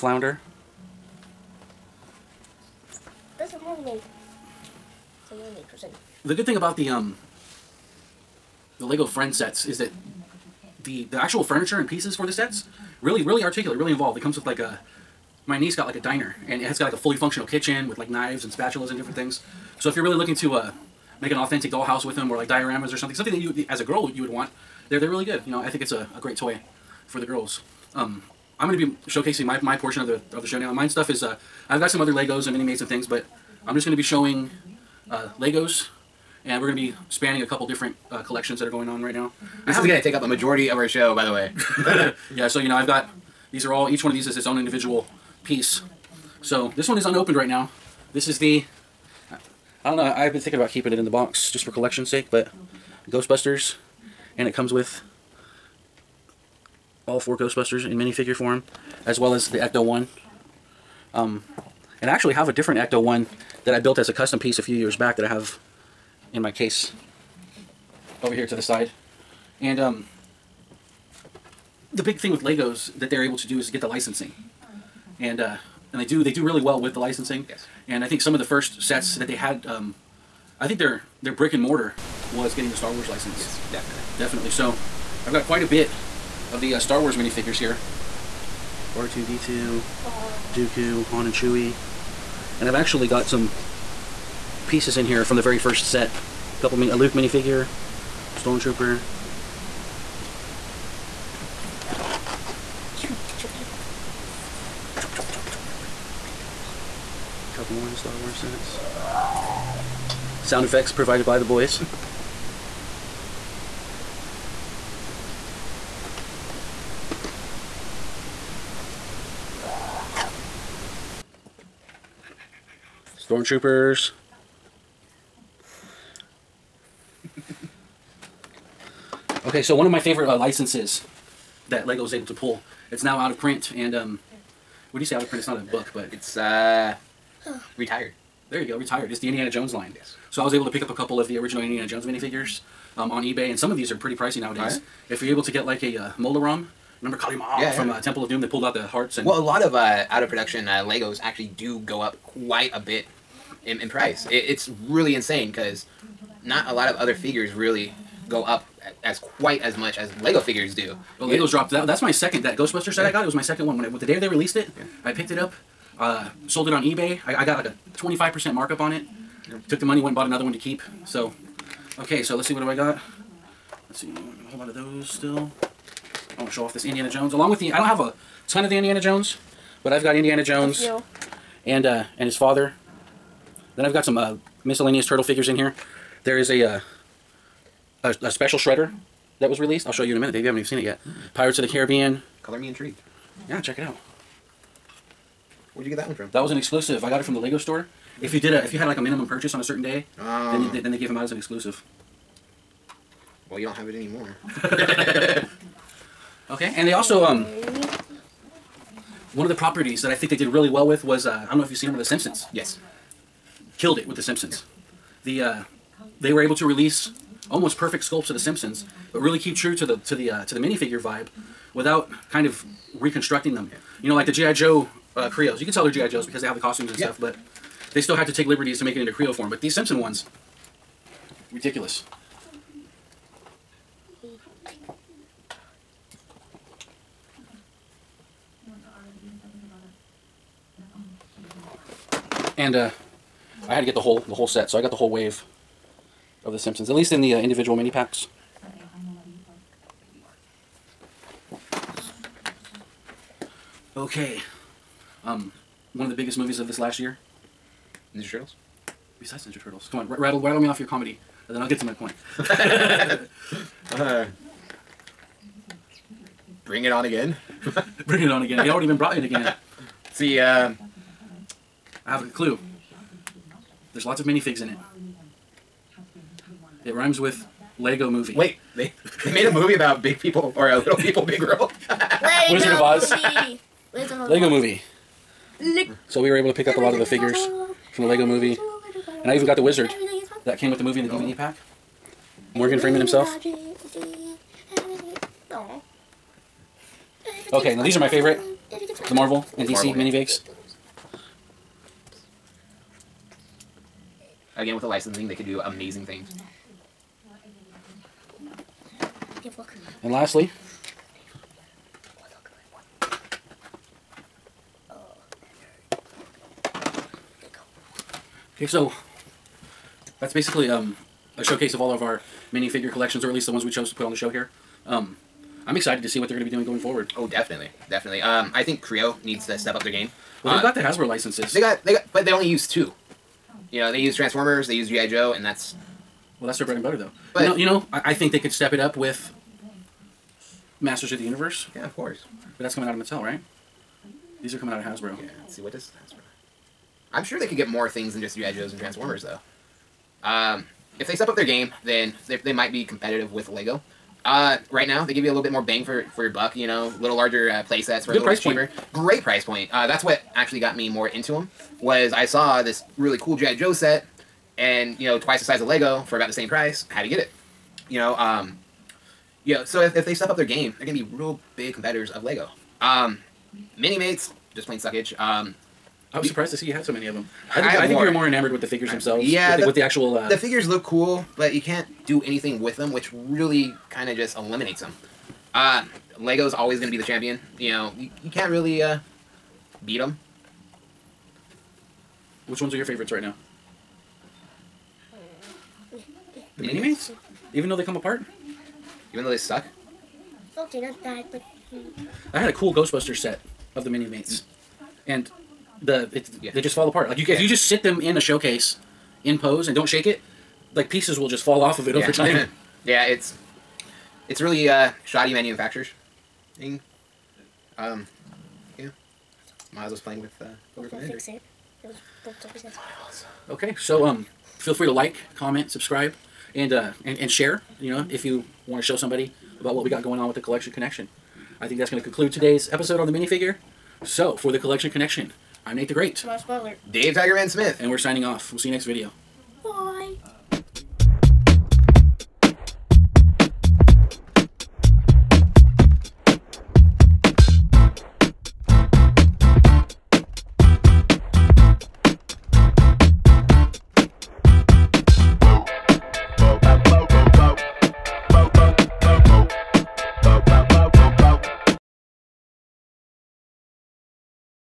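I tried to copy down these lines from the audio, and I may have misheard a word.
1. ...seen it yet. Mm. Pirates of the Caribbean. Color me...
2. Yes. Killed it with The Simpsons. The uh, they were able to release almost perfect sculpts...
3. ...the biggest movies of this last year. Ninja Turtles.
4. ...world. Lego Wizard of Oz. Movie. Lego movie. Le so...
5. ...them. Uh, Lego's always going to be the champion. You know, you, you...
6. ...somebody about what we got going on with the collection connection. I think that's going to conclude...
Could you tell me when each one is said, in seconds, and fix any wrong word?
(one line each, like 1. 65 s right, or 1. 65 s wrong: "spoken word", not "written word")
1. 190 s right
2. 212 s right
3. 256 s right
4. 281 s right
5. 384 s right
6. 428 s right.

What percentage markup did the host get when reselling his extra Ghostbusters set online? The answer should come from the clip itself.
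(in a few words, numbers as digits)
25%.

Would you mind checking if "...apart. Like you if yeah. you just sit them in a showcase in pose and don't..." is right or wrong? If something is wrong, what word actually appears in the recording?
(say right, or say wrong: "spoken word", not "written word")
right.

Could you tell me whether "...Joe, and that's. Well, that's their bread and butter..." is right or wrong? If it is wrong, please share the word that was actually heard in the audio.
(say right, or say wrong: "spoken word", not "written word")
right.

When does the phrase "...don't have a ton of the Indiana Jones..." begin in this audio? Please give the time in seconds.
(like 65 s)
177 s.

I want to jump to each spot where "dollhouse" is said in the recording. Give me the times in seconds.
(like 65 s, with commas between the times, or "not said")
21 s.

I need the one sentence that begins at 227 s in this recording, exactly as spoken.
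stuff, but they still had to take liberties to make it into Kreo form.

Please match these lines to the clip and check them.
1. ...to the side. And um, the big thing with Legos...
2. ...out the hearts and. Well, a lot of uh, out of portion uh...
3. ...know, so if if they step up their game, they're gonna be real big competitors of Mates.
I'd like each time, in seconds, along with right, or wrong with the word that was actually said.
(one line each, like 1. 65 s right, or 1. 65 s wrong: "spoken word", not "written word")
1. 68 s right
2. 148 s wrong: "production", not "portion"
3. 369 s wrong: "Lego", not "Mates".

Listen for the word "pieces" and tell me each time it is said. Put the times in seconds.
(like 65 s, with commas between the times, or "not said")
11 s, 45 s, 64 s, 94 s, 410 s.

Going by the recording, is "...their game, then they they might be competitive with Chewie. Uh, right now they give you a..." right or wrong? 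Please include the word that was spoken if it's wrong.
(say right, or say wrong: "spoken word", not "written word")
wrong: "Lego", not "Chewie".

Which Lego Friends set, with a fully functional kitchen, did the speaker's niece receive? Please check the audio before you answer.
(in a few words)
Diner.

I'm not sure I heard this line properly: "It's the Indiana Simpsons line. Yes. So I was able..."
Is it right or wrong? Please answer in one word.
wrong.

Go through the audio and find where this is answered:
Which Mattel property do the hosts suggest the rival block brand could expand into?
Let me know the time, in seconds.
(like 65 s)
340 s.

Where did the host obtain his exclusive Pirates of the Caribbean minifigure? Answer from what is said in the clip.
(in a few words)
The Lego store.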